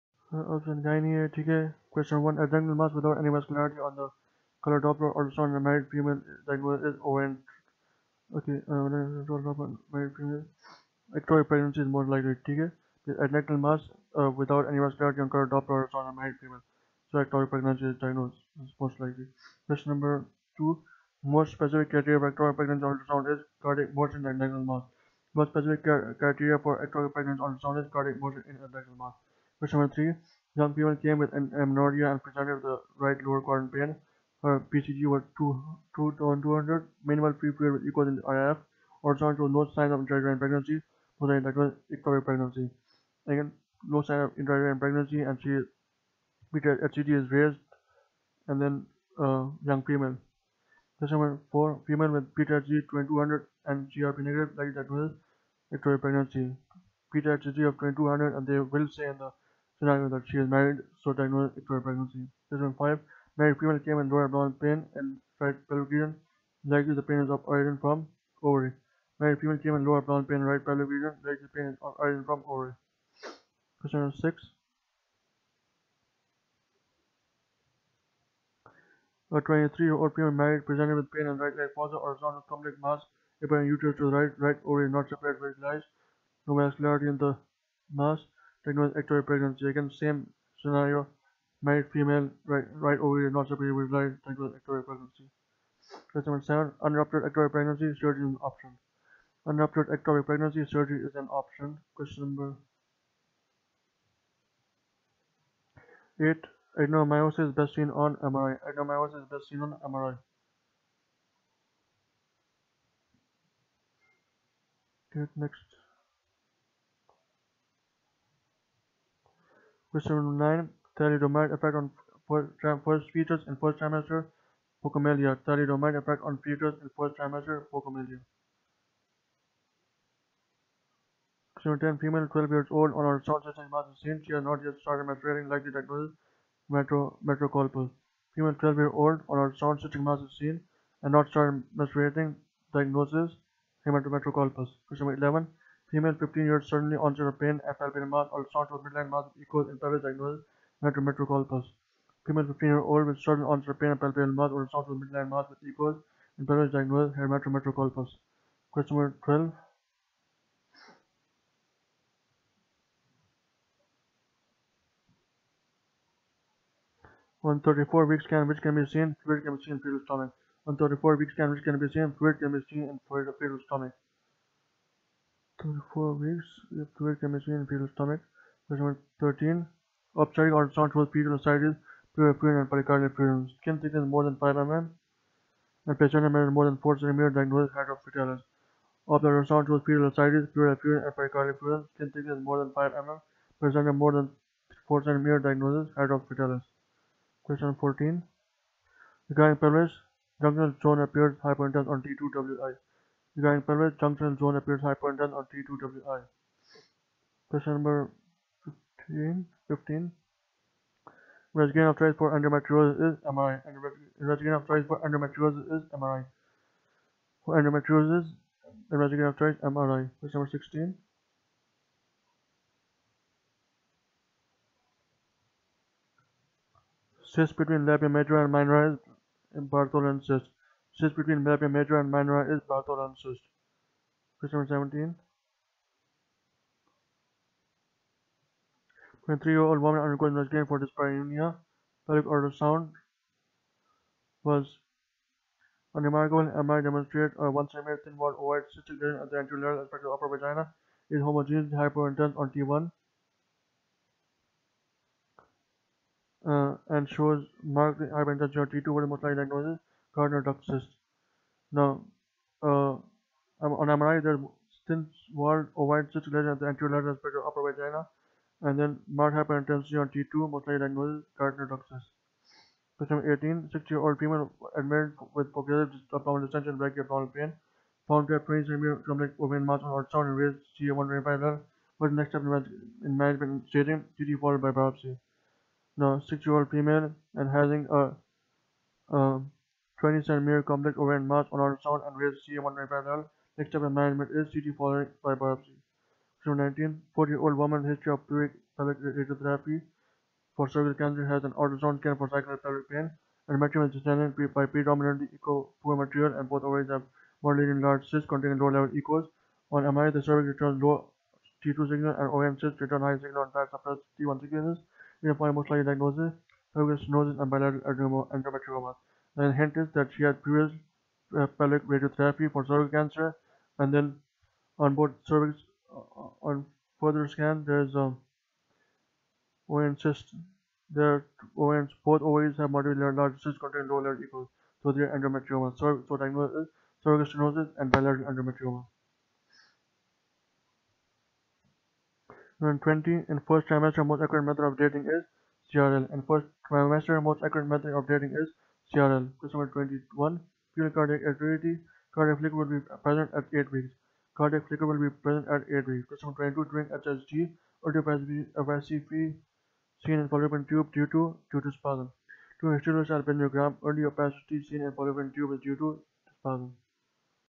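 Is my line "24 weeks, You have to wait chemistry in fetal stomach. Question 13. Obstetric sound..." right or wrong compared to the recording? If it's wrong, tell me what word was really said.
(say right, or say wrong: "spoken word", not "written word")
wrong: "ultrasound", not "sound".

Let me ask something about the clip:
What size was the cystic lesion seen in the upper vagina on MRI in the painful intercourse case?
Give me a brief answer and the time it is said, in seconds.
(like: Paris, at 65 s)
1 cm, at 247 s.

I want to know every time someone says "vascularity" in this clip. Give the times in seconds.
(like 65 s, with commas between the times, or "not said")
3 s, 14 s, 86 s.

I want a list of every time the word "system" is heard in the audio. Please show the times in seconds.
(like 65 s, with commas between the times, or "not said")
133 s, 139 s.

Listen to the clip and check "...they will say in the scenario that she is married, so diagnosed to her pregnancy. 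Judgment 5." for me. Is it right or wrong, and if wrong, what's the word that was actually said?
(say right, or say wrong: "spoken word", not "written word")
right.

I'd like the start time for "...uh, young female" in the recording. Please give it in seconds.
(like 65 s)
49 s.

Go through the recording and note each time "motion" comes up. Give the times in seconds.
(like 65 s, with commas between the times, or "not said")
23 s, 28 s.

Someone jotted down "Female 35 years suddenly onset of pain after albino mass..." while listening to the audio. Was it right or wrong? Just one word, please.
wrong.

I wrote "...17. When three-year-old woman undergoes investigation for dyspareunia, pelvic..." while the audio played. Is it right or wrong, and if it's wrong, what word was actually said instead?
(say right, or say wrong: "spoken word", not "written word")
right.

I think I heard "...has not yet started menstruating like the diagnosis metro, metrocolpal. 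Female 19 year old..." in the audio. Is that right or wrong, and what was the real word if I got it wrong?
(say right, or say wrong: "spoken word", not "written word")
wrong: "12", not "19".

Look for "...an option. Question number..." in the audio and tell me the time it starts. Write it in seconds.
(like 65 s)
101 s.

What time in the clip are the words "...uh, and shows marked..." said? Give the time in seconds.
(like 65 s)
256 s.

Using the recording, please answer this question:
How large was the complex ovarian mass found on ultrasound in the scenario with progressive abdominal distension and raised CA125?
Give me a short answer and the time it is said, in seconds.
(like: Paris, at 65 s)
20 cm, at 278 s.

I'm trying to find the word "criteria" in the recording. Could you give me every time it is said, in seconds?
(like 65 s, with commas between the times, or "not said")
21 s, 26 s.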